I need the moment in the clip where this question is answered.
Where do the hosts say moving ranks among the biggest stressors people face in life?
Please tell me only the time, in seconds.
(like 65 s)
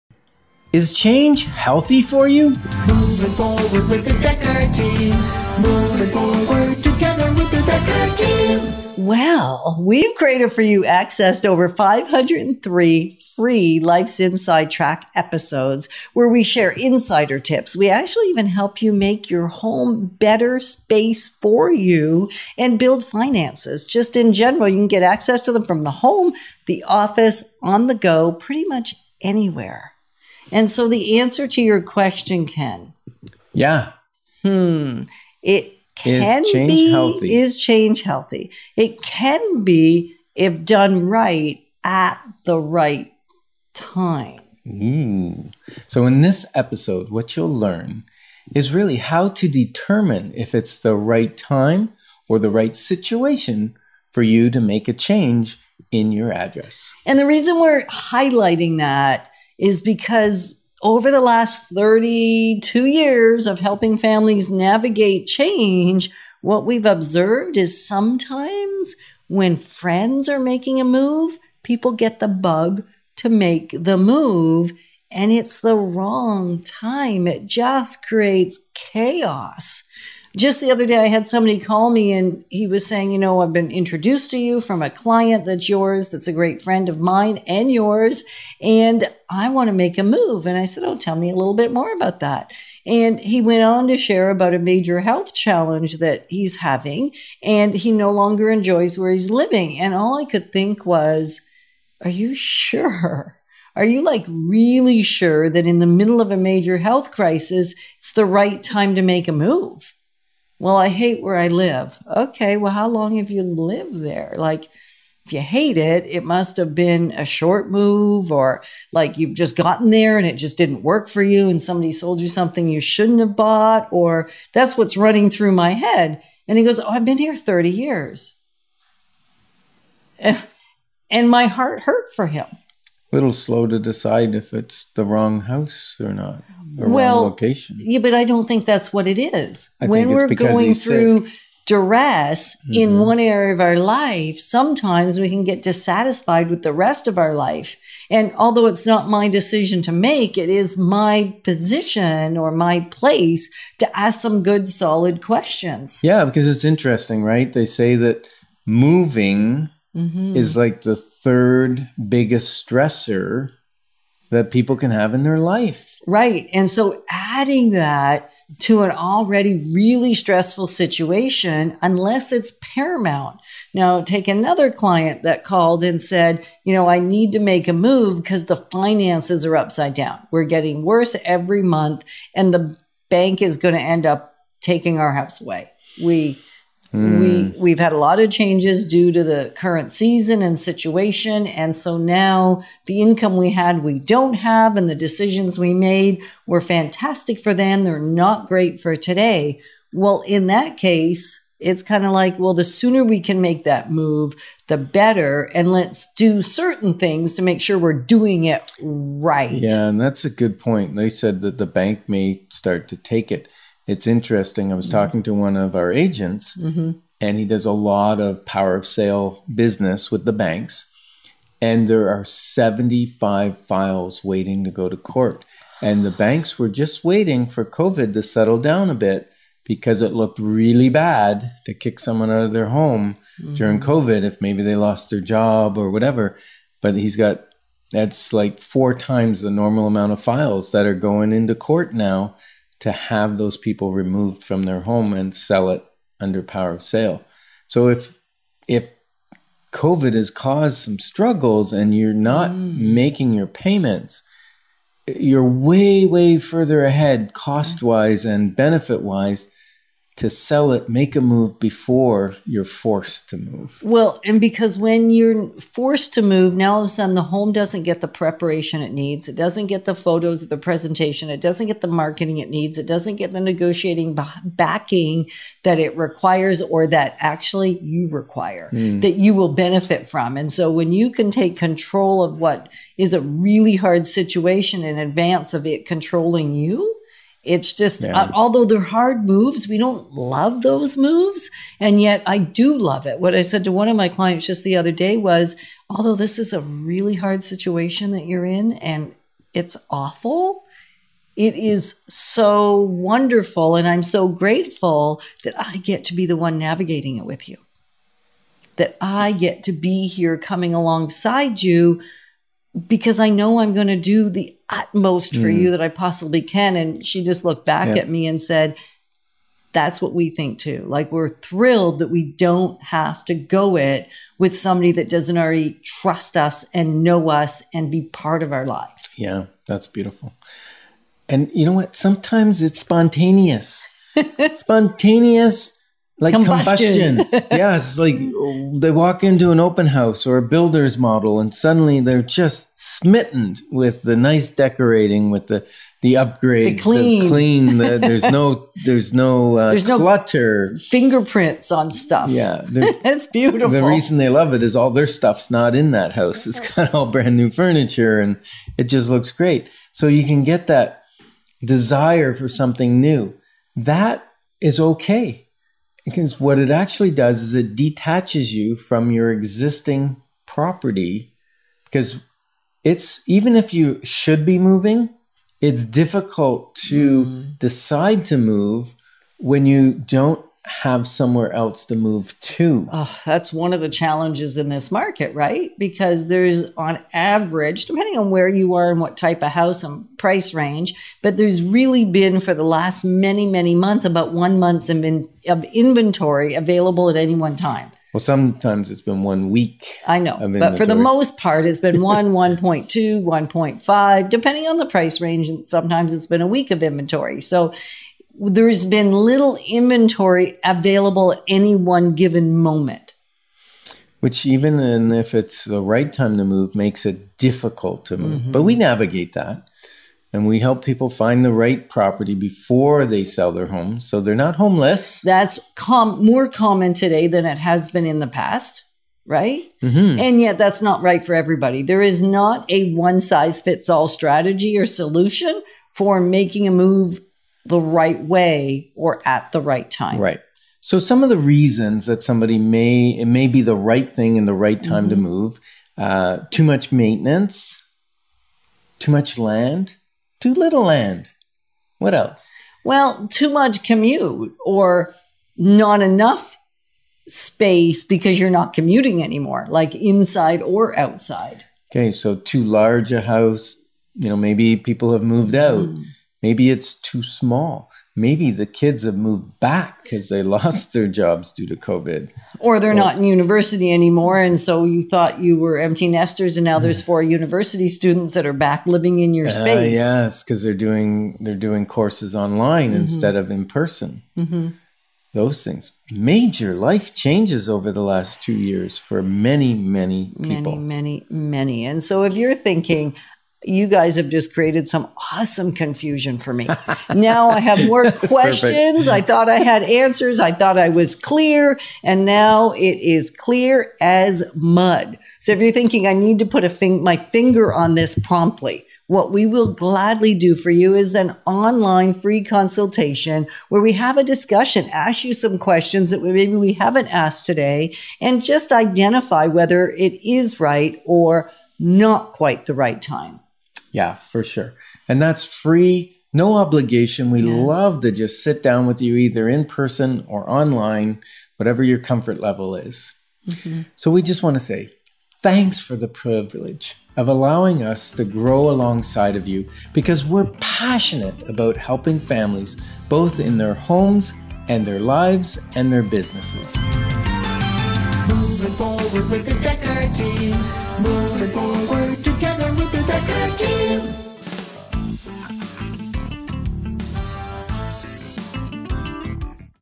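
160 s.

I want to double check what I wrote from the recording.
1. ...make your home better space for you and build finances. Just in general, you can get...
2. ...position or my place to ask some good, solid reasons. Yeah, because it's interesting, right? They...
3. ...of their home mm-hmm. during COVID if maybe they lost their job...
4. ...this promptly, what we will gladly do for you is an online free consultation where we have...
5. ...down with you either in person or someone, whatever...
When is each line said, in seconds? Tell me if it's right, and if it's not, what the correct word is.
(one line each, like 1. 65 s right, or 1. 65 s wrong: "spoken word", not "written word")
1. 18 s right
2. 151 s wrong: "questions", not "reasons"
3. 232 s right
4. 507 s right
5. 528 s wrong: "online", not "someone".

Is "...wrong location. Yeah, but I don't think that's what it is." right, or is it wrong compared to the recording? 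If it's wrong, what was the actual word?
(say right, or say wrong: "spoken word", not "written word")
right.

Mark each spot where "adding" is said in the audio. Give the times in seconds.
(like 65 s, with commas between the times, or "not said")
167 s.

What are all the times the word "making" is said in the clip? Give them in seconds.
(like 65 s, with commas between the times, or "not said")
70 s, 252 s, 436 s.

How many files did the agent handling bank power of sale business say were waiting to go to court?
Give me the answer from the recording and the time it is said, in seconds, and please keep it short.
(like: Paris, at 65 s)
75, at 222 s.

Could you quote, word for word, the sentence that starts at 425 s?
That's com- more common today than it has been in the past, right?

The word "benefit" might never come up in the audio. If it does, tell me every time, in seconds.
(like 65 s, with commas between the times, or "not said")
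258 s, 279 s.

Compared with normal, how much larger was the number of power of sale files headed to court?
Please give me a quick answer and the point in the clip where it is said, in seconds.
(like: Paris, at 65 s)
Four times, at 238 s.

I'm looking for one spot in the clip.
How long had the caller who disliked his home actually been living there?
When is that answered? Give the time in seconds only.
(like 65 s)
127 s.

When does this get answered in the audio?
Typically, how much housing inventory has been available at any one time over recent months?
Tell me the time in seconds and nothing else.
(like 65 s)
394 s.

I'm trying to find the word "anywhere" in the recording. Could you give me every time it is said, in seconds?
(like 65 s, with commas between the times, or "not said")
29 s.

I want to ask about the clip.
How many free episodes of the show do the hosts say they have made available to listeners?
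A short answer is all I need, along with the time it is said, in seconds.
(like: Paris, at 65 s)
503, at 11 s.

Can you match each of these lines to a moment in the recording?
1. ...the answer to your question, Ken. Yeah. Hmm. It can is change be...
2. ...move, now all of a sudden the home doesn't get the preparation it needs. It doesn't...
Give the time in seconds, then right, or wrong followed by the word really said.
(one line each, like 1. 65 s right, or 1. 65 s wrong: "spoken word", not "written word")
1. 30 s right
2. 266 s right.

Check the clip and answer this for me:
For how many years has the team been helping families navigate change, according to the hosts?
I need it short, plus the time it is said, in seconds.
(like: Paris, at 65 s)
32, at 61 s.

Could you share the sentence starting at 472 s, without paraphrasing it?
Or they're or, not in university anymore.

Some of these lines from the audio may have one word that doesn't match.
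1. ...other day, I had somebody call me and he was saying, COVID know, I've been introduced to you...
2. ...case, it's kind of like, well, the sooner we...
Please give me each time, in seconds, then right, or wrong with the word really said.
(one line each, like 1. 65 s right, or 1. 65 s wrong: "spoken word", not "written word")
1. 80 s wrong: "You", not "COVID"
2. 200 s right.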